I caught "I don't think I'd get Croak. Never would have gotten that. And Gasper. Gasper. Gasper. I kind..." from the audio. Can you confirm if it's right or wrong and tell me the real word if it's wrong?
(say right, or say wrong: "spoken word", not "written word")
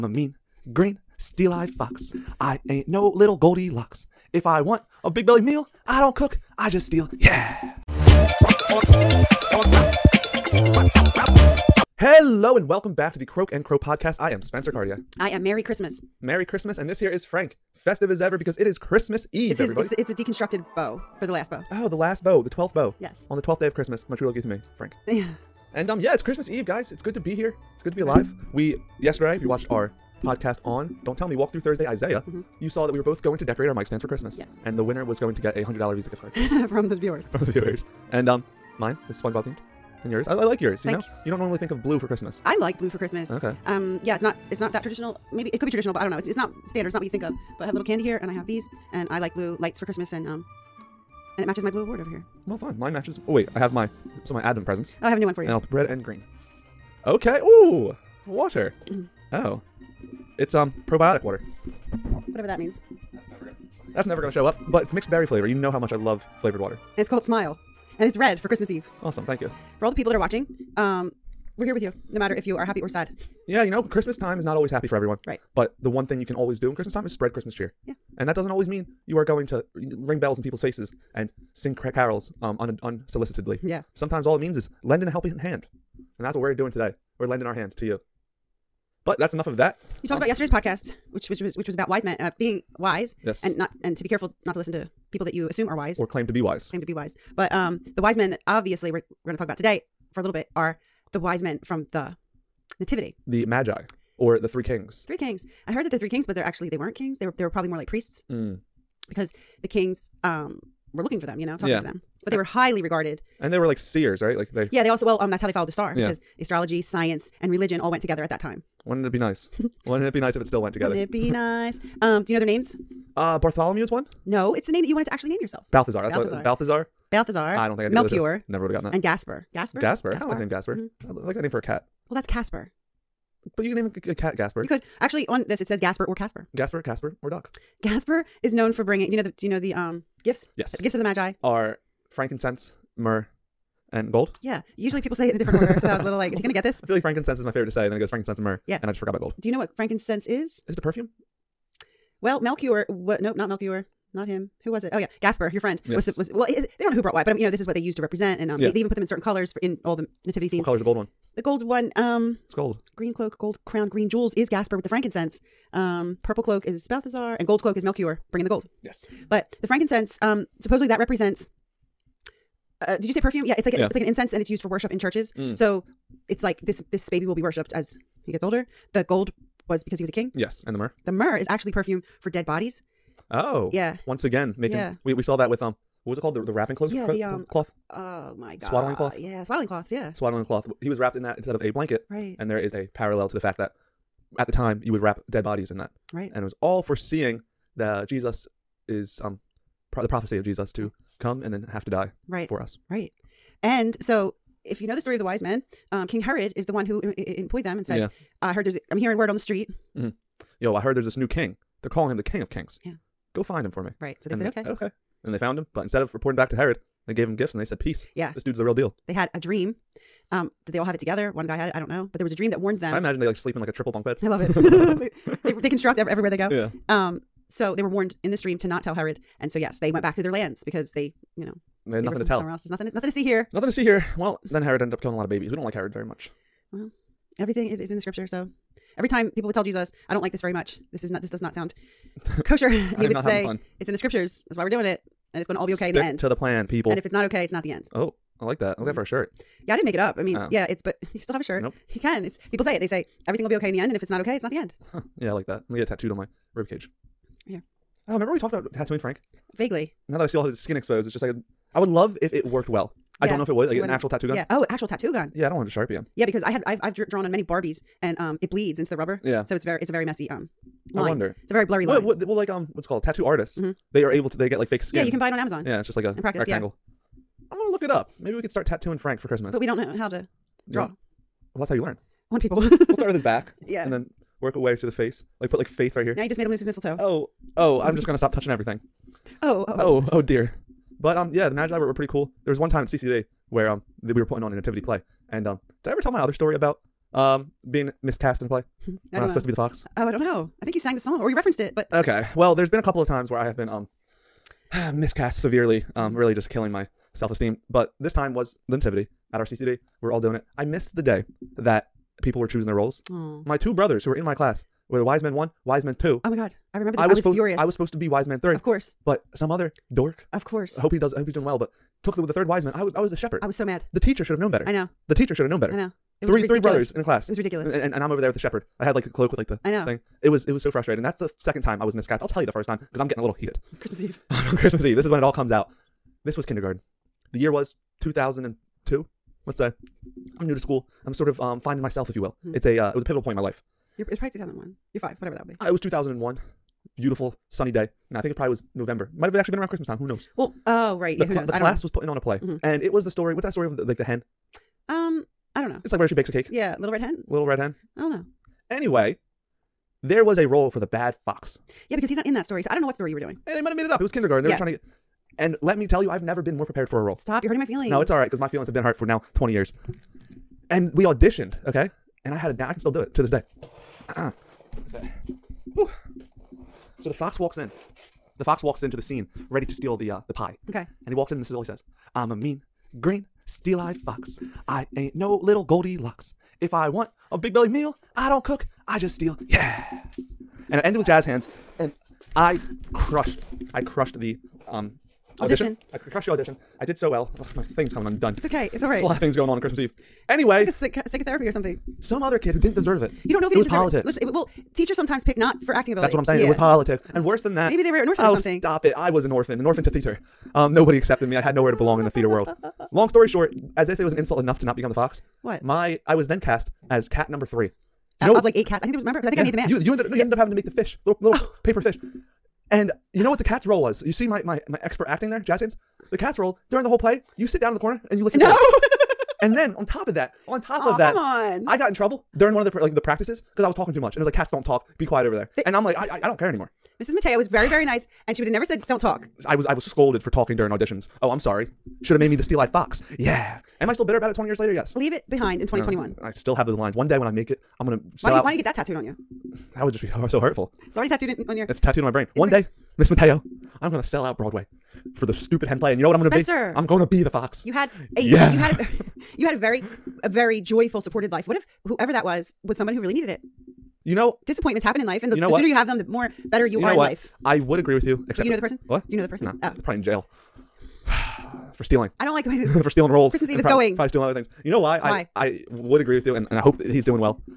wrong: "Melchior", not "Croak".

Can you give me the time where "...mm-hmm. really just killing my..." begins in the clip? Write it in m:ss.
5:06.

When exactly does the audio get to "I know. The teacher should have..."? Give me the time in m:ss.
5:24.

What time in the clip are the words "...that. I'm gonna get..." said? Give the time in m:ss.
4:15.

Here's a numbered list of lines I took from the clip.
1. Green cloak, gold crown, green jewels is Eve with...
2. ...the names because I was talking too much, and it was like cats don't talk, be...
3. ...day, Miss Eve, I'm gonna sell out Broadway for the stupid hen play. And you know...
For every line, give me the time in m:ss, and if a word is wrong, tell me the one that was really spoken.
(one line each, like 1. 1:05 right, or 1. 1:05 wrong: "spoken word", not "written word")
1. 2:42 wrong: "Gasper", not "Eve"
2. 7:12 wrong: "practices", not "names"
3. 7:32 wrong: "Mateo", not "Eve".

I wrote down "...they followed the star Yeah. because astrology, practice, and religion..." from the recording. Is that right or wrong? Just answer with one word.
wrong.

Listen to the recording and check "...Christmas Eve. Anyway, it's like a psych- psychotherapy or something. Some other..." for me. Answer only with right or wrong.
right.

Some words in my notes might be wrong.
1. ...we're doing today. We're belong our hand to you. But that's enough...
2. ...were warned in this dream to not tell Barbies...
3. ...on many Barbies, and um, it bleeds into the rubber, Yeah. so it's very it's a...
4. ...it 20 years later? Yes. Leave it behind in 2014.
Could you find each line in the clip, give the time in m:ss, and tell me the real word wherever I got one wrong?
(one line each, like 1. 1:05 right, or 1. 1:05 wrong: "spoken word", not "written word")
1. 1:26 wrong: "lending", not "belong"
2. 3:47 wrong: "Herod", not "Barbies"
3. 4:27 right
4. 7:24 wrong: "2021", not "2014".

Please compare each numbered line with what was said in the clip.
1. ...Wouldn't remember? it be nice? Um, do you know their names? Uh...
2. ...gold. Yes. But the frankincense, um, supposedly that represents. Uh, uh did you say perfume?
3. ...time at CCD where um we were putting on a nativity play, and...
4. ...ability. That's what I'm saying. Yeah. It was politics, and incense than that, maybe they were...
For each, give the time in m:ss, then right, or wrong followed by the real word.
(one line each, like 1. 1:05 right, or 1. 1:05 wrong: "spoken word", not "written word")
1. 2:00 wrong: "together", not "remember"
2. 2:48 right
3. 4:52 right
4. 6:45 wrong: "worse", not "incense".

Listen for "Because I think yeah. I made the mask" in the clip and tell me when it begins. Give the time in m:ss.
6:59.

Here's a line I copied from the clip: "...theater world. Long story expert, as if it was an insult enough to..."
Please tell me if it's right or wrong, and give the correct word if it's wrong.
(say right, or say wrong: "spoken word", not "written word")
wrong: "short", not "expert".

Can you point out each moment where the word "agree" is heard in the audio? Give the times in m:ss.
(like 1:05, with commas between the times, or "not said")
7:47, 7:55.